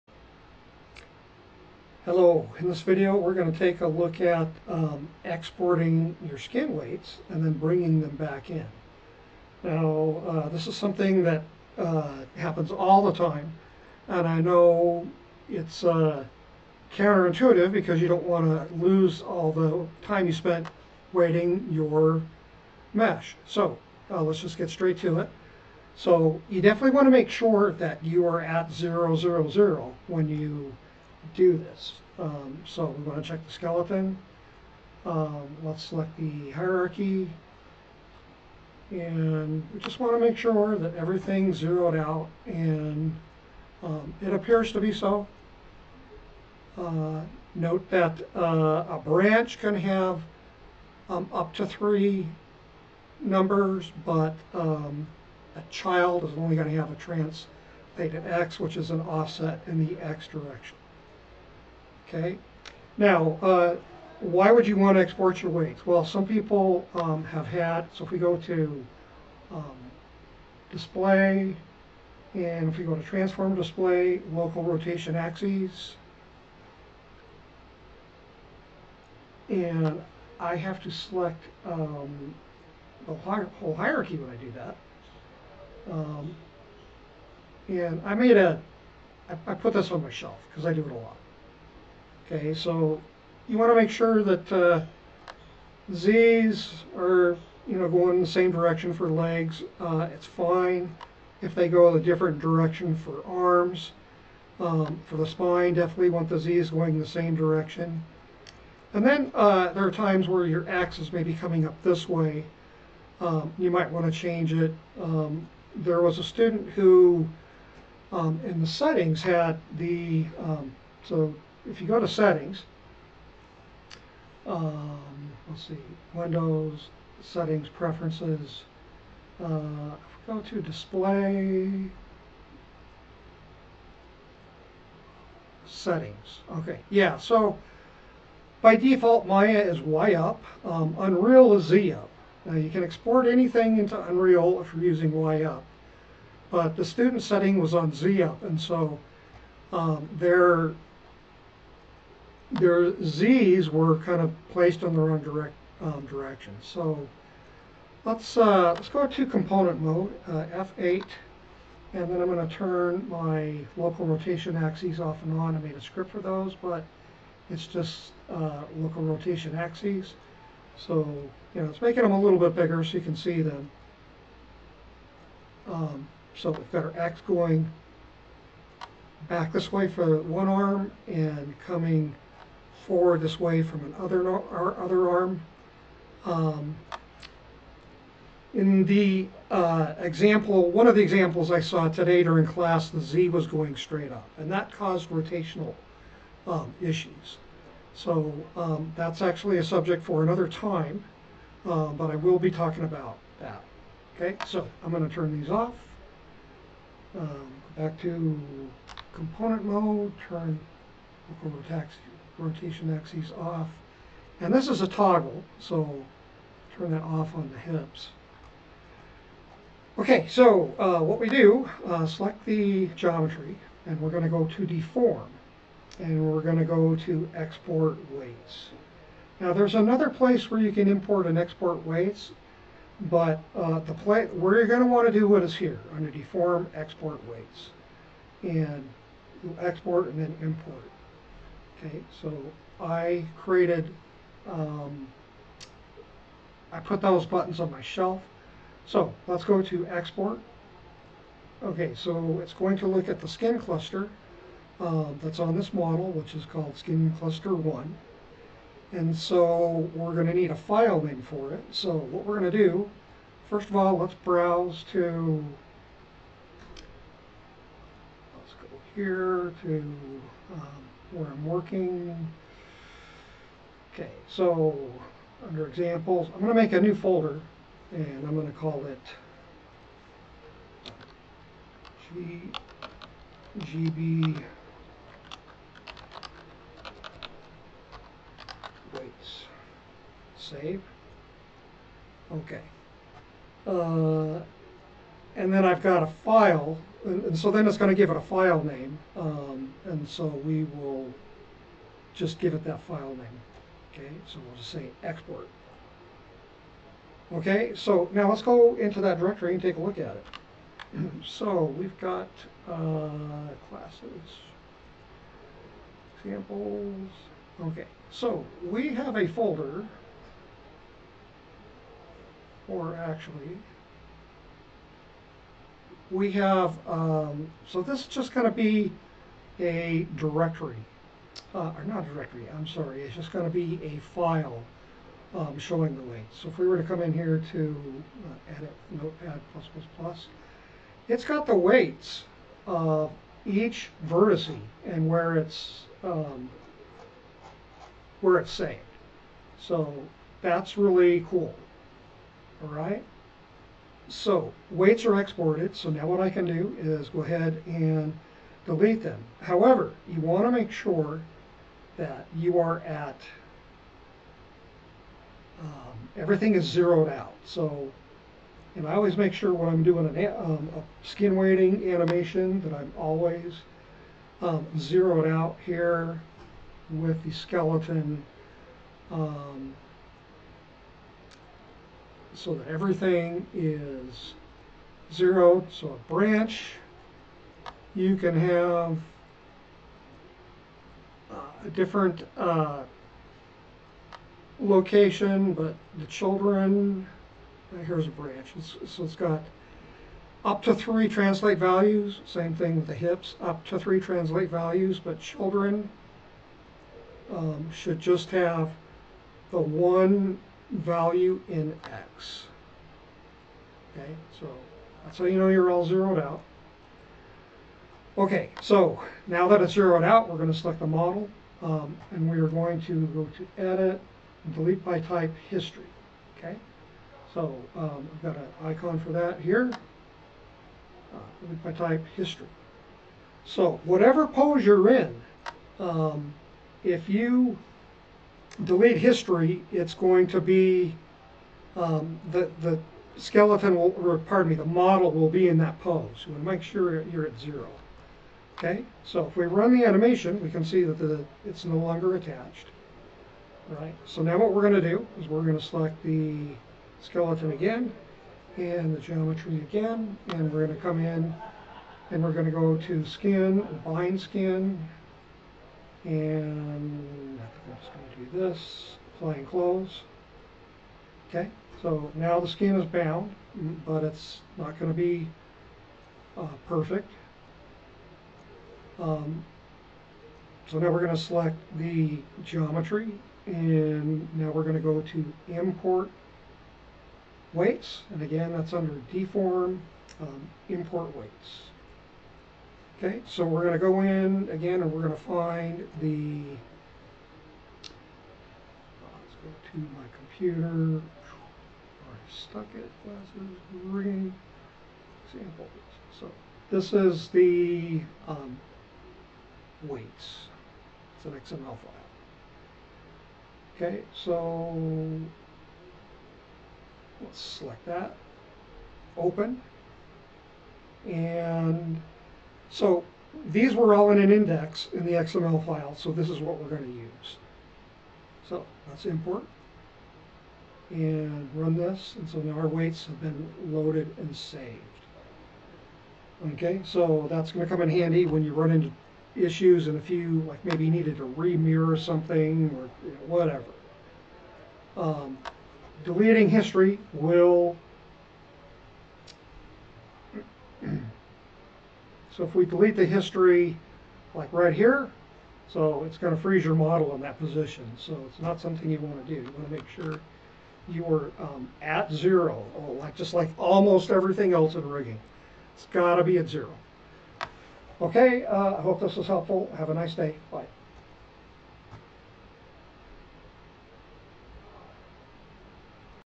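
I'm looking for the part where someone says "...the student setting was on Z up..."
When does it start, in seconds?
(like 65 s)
146 s.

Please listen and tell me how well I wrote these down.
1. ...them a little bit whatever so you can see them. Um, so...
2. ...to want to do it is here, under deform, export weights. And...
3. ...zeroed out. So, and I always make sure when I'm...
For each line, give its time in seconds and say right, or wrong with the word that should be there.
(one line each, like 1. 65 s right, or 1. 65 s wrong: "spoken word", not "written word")
1. 172 s wrong: "bigger", not "whatever"
2. 234 s right
3. 366 s right.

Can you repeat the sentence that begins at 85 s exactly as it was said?
Um, and I made a, I, I put this on my shelf because I do it a lot.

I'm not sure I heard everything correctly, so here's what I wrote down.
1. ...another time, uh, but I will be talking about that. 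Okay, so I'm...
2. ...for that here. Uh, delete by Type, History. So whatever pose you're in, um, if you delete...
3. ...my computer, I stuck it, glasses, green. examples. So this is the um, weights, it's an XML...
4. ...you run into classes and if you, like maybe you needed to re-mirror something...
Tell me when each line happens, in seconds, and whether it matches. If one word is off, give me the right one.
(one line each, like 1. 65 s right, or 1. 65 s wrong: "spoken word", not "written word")
1. 200 s right
2. 428 s right
3. 499 s right
4. 538 s wrong: "issues", not "classes".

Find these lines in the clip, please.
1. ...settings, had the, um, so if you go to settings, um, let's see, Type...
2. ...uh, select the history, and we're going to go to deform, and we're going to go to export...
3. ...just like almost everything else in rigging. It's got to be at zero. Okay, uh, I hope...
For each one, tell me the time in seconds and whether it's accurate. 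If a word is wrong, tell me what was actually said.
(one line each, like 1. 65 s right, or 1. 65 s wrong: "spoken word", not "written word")
1. 118 s wrong: "Windows", not "Type"
2. 221 s wrong: "geometry", not "history"
3. 563 s right.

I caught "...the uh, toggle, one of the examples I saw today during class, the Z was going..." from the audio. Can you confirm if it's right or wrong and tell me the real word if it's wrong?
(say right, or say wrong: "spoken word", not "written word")
wrong: "example", not "toggle".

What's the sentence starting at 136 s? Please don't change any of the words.
Okay, yeah, so by default Maya is Y up, um, Unreal is Z up.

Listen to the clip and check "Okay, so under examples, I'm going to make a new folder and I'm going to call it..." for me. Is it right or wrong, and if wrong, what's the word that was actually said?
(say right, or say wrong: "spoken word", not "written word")
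right.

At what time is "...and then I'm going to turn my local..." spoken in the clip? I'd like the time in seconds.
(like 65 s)
161 s.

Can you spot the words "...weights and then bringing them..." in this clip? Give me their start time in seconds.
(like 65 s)
6 s.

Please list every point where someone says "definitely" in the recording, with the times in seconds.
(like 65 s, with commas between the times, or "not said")
26 s, 105 s.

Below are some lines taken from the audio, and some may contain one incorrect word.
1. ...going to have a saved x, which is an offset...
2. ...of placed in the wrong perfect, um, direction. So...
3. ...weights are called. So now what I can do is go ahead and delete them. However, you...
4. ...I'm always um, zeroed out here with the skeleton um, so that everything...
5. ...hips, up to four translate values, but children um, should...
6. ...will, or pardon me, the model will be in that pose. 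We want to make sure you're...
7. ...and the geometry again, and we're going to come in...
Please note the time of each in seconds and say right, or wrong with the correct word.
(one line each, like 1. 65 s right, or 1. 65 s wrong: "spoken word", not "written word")
1. 56 s wrong: "translated", not "saved"
2. 154 s wrong: "direct", not "perfect"
3. 354 s wrong: "exported", not "called"
4. 372 s right
5. 402 s wrong: "three", not "four"
6. 443 s right
7. 458 s right.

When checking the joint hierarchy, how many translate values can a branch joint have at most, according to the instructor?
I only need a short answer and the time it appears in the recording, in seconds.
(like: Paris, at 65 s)
3, at 51 s.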